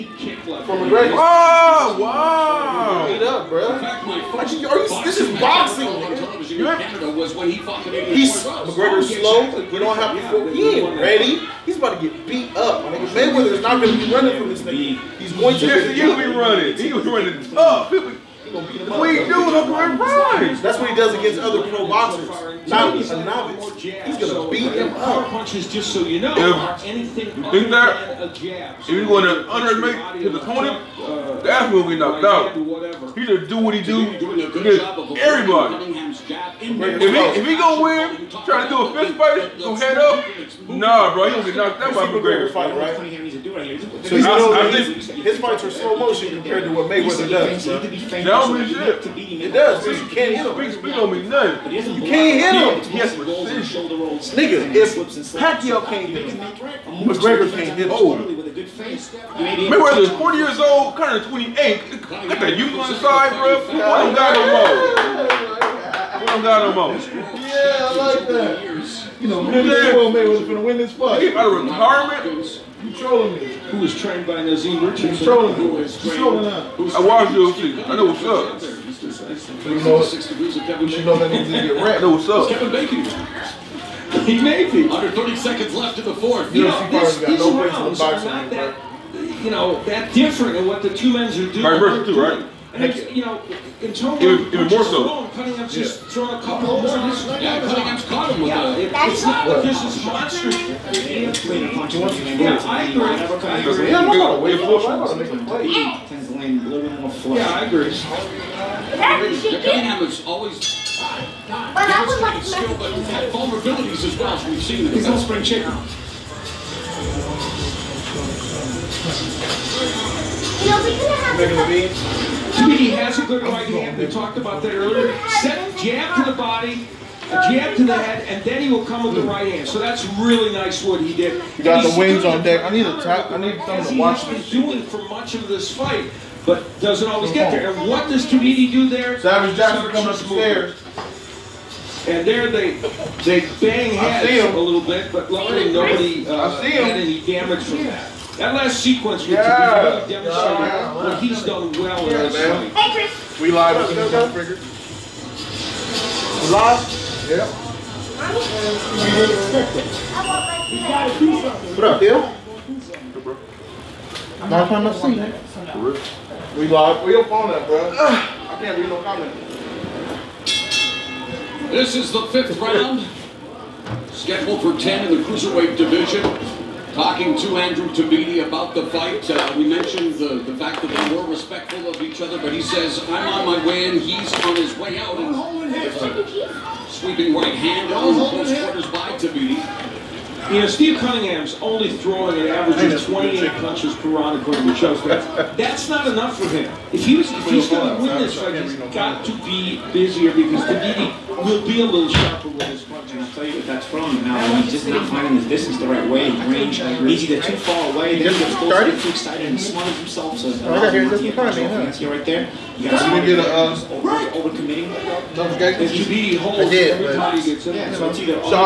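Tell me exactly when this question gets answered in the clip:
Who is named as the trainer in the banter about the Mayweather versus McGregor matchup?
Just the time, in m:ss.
1:14.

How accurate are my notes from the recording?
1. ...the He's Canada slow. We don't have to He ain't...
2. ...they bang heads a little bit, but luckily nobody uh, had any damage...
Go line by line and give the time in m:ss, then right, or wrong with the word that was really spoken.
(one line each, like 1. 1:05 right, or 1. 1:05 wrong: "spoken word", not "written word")
1. 0:07 wrong: "McGregor", not "Canada"
2. 2:23 right.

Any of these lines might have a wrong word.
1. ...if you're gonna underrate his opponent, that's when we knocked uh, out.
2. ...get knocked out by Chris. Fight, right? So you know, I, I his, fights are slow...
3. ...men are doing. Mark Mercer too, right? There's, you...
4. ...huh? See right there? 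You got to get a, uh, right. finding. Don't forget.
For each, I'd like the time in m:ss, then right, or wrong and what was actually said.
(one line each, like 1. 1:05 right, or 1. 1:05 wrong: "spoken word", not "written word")
1. 0:28 right
2. 0:41 wrong: "McGregor", not "Chris"
3. 1:31 right
4. 3:31 wrong: "overcommitting", not "finding".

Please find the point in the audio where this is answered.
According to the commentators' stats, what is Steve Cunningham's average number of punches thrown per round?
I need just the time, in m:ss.
3:13.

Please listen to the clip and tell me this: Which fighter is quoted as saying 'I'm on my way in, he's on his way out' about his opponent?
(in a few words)
Andrew Tabiti.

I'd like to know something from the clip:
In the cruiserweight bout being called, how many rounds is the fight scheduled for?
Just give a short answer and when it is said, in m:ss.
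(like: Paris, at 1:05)
10, at 2:54.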